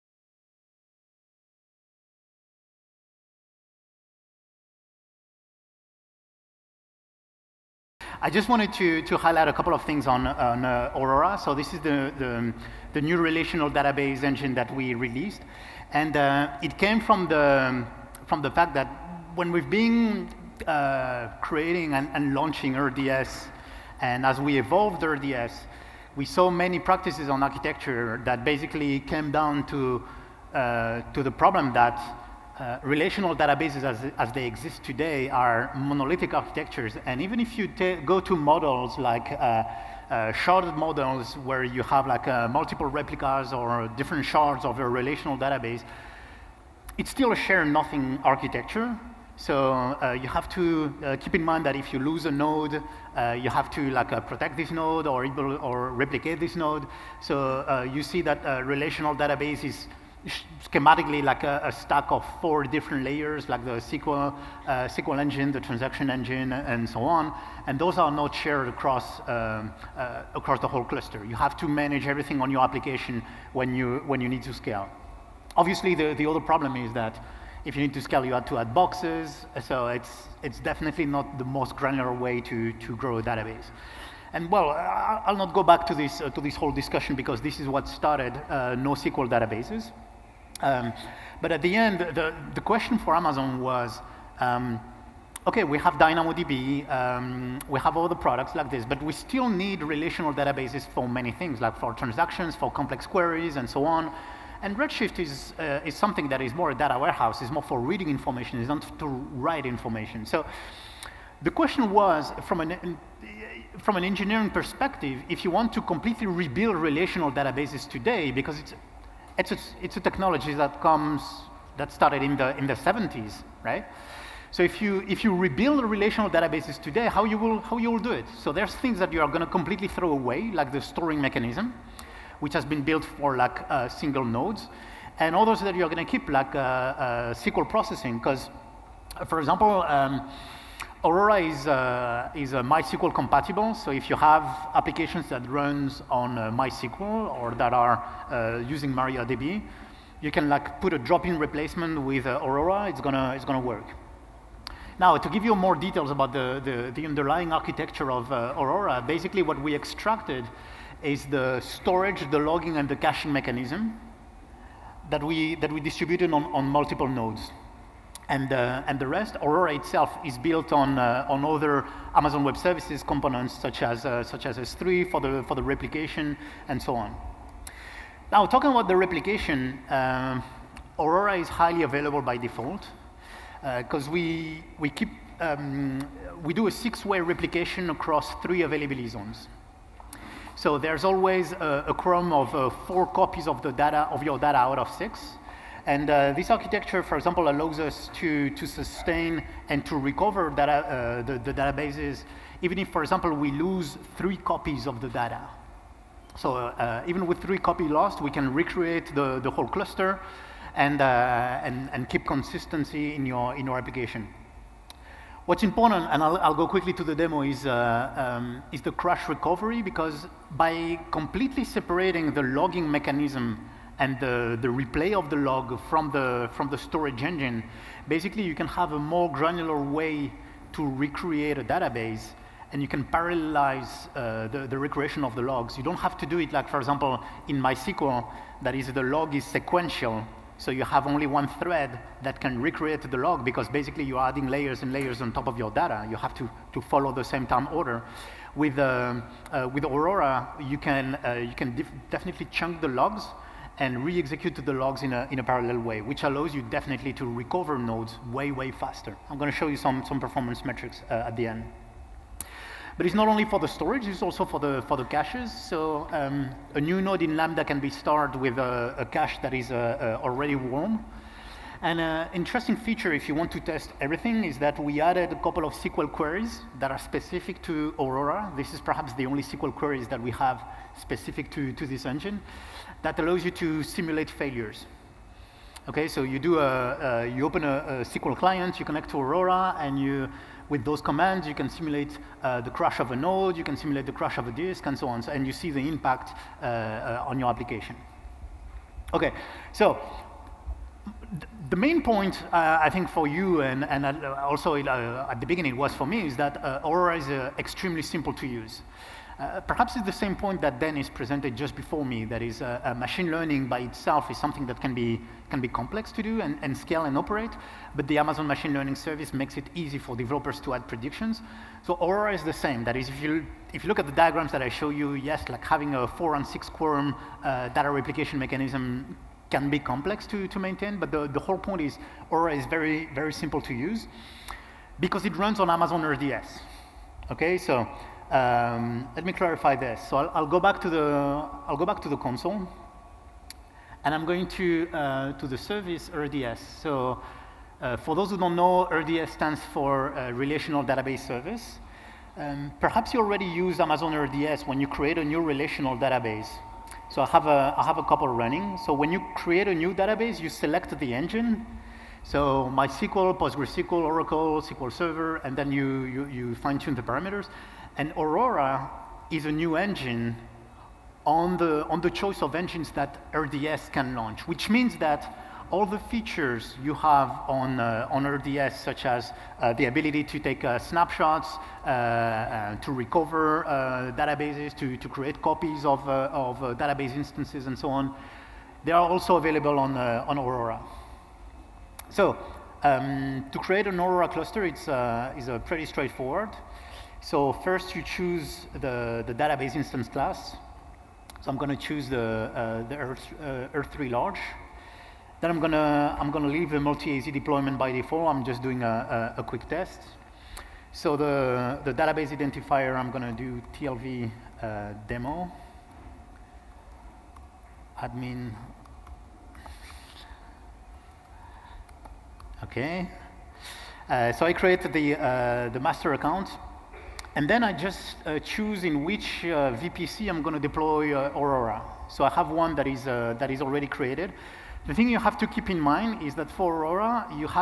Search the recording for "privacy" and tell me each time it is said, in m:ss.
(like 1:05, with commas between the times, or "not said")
not said.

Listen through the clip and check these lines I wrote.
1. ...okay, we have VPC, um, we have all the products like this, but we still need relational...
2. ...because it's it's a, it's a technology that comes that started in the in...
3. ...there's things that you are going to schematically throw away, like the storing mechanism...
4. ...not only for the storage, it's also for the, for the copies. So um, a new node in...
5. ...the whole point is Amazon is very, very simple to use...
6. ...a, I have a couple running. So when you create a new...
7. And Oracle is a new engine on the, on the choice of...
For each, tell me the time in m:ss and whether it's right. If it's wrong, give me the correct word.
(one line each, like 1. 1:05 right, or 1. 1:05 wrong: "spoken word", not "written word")
1. 1:35 wrong: "DynamoDB", not "VPC"
2. 1:58 right
3. 2:08 wrong: "completely", not "schematically"
4. 4:23 wrong: "caches", not "copies"
5. 5:31 wrong: "Aurora", not "Amazon"
6. 5:57 right
7. 6:07 wrong: "Aurora", not "Oracle".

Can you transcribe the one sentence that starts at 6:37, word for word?
So first you choose the, the database instance class.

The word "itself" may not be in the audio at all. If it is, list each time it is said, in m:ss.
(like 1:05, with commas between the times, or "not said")
2:49, 5:13.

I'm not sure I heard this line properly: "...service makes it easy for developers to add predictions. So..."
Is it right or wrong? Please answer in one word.
right.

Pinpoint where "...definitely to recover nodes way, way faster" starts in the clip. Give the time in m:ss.
4:16.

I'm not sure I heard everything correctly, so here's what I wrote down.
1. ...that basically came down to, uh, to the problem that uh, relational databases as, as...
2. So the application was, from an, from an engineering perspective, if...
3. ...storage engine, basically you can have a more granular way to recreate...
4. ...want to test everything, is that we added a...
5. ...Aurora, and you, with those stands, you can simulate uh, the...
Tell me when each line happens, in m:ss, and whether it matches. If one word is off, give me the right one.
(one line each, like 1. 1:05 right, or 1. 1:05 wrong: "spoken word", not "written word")
1. 0:28 right
2. 1:50 wrong: "question", not "application"
3. 3:46 right
4. 4:33 right
5. 4:49 wrong: "commands", not "stands".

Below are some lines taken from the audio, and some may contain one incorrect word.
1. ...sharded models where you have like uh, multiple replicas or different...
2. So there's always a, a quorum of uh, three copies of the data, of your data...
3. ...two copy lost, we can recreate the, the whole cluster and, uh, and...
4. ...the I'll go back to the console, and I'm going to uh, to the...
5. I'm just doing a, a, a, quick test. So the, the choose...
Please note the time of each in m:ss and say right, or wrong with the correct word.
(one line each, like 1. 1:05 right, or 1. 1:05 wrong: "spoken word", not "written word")
1. 0:40 right
2. 3:10 wrong: "four", not "three"
3. 3:27 wrong: "three", not "two"
4. 5:40 right
5. 6:48 wrong: "database", not "choose".